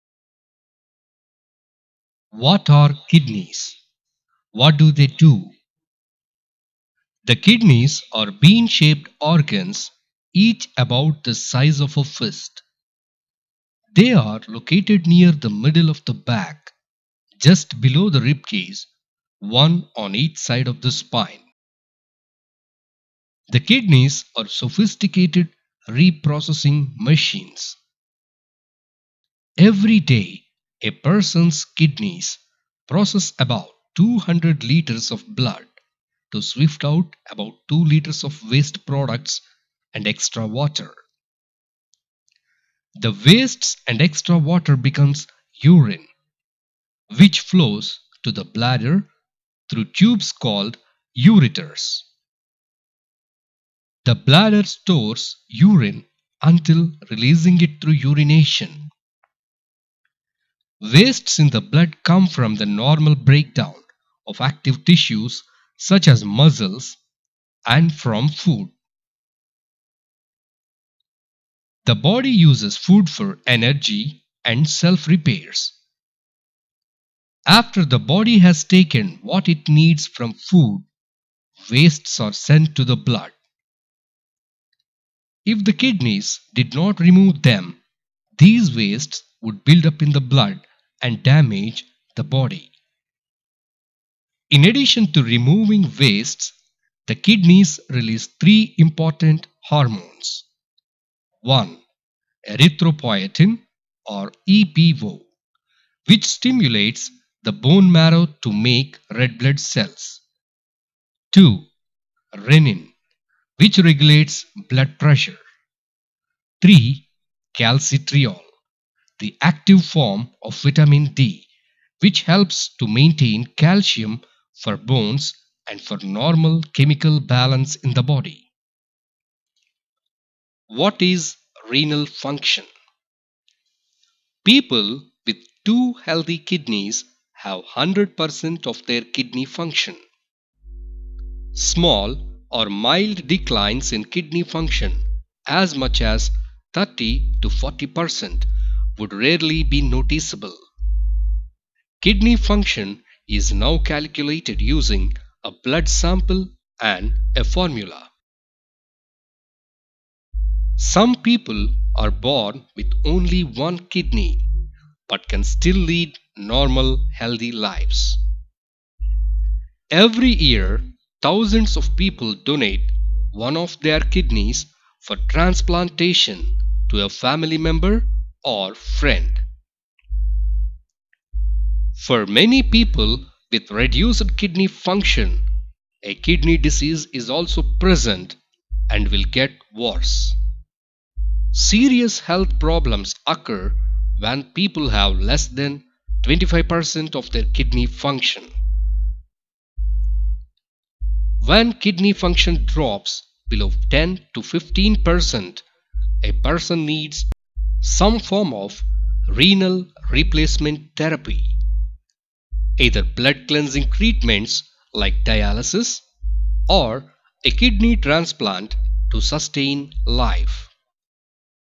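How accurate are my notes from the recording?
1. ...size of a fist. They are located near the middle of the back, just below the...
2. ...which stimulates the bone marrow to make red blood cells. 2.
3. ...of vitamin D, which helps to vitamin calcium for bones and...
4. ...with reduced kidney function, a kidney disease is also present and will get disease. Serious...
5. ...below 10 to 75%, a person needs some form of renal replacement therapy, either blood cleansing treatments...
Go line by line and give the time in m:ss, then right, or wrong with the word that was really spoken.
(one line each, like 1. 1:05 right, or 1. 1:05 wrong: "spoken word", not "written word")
1. 0:11 right
2. 1:46 right
3. 2:00 wrong: "maintain", not "vitamin"
4. 3:03 wrong: "worse", not "disease"
5. 3:23 wrong: "15", not "75".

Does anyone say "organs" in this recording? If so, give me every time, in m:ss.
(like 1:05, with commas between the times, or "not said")
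0:09.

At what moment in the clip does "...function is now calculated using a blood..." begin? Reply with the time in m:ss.
2:32.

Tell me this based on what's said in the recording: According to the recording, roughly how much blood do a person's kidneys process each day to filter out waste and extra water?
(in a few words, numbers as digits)
200 liters.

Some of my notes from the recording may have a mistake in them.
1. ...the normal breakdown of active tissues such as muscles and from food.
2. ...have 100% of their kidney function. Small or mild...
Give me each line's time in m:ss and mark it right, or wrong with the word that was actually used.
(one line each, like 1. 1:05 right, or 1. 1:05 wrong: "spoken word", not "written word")
1. 1:02 right
2. 2:17 right.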